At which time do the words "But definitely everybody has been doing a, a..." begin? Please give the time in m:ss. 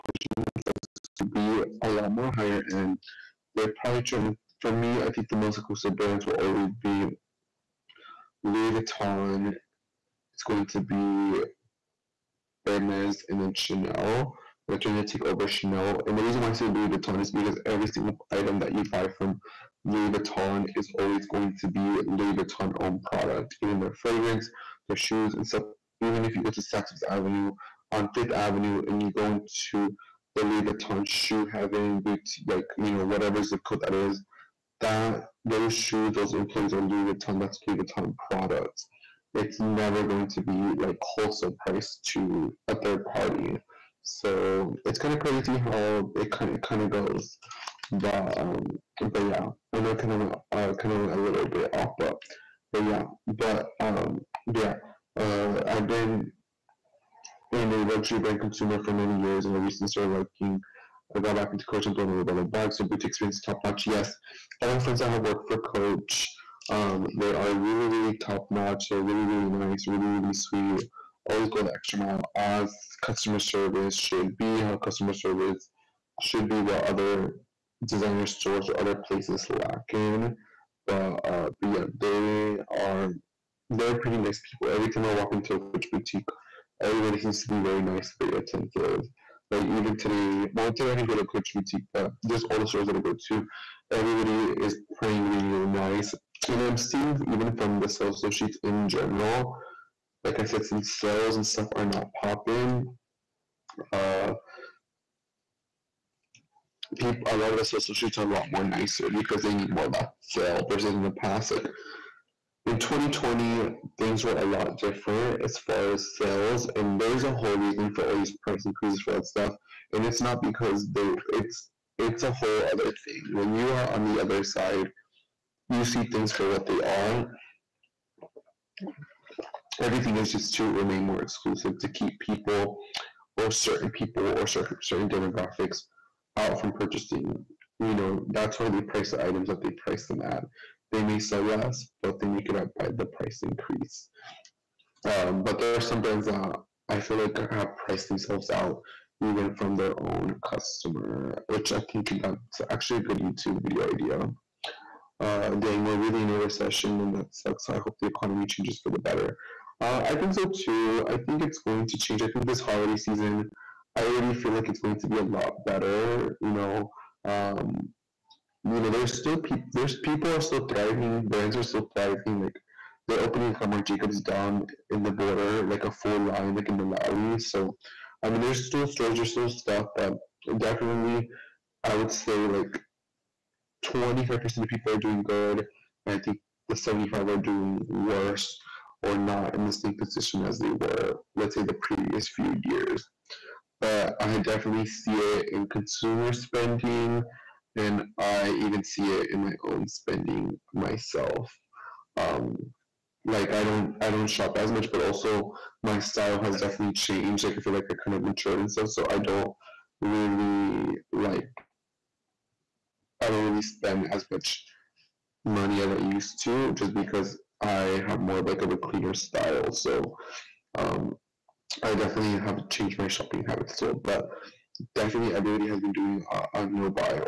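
3:44.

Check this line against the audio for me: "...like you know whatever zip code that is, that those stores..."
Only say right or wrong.
wrong.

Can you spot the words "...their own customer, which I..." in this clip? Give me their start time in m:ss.
2:29.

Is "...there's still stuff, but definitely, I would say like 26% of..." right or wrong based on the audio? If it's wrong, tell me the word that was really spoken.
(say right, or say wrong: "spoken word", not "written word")
wrong: "25", not "26".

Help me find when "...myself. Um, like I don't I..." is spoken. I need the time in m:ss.
3:20.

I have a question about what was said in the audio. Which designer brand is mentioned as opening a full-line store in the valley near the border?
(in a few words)
Marc Jacobs.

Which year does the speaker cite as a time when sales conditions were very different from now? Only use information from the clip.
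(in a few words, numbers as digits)
2020.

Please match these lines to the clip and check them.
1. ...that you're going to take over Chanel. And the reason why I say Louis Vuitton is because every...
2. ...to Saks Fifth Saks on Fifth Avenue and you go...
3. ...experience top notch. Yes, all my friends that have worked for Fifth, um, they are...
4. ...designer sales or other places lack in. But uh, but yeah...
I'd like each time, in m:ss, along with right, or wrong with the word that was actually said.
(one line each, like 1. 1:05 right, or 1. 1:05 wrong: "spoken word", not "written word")
1. 0:14 right
2. 0:26 wrong: "Avenue", not "Saks"
3. 1:03 wrong: "Coach", not "Fifth"
4. 1:17 wrong: "stores", not "sales".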